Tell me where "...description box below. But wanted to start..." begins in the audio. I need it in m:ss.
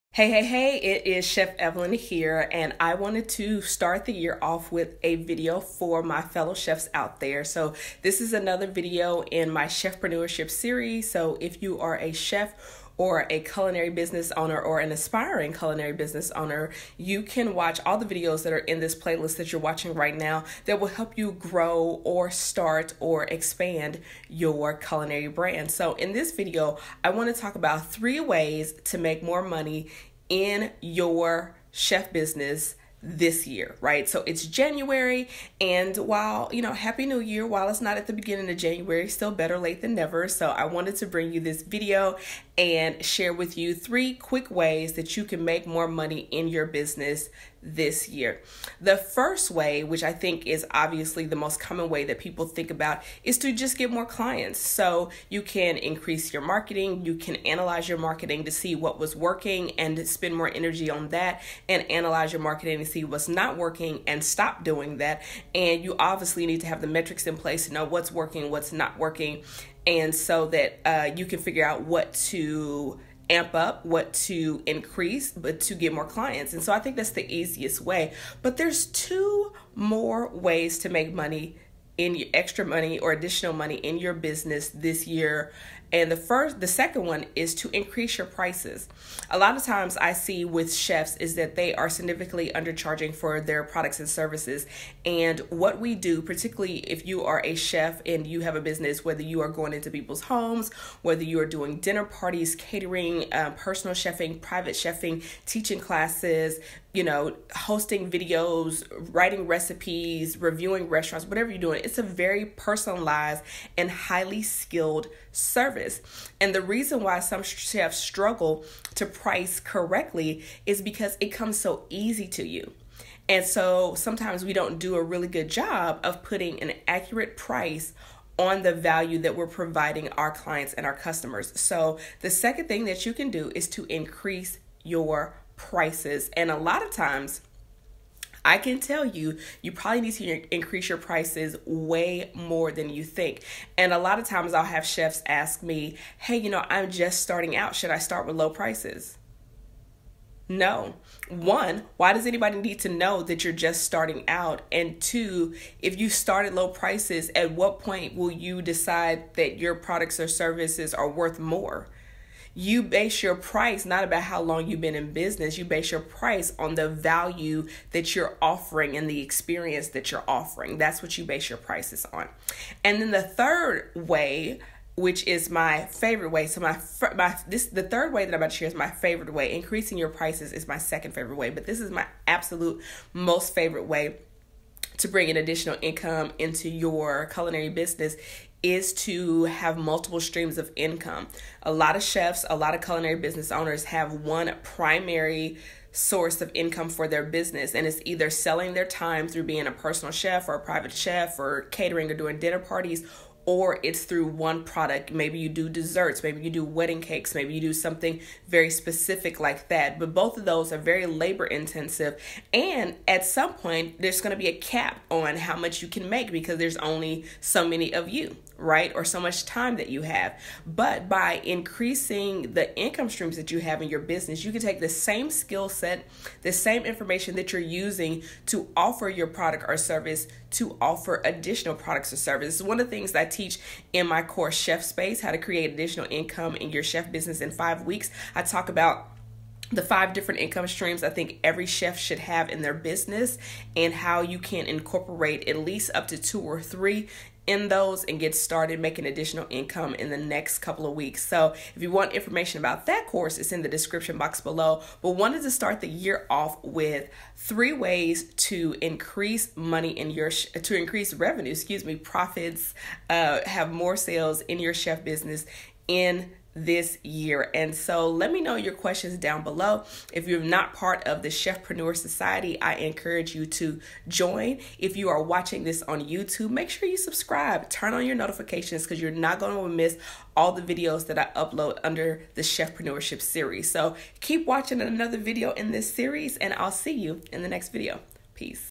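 4:13.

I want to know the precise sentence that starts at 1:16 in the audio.
And so I think that's the easiest way.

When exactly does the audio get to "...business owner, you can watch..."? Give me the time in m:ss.
0:15.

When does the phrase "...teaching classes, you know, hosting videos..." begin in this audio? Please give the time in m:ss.
1:45.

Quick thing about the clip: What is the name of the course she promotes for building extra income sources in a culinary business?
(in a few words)
Chef Space.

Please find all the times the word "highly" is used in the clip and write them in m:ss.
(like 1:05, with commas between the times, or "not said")
1:53.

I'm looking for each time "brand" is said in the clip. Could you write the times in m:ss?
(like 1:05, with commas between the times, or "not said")
0:25.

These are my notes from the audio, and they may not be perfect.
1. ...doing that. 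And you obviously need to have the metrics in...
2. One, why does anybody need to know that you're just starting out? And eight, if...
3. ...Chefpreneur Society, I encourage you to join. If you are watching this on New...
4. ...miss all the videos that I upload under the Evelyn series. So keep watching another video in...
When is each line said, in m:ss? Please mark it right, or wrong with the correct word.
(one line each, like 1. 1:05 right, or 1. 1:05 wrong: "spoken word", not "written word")
1. 1:04 right
2. 2:31 wrong: "two", not "eight"
3. 4:31 wrong: "YouTube", not "New"
4. 4:39 wrong: "Chefpreneurship", not "Evelyn".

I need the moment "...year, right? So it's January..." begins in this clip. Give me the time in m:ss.
0:33.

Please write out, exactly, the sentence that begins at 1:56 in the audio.
And the reason why some chefs struggle to price correctly is because it comes so easy to you.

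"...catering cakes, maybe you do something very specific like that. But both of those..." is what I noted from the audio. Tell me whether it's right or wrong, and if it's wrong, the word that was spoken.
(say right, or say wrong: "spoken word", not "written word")
wrong: "wedding", not "catering".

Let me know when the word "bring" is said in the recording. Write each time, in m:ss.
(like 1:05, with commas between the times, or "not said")
0:41, 3:05.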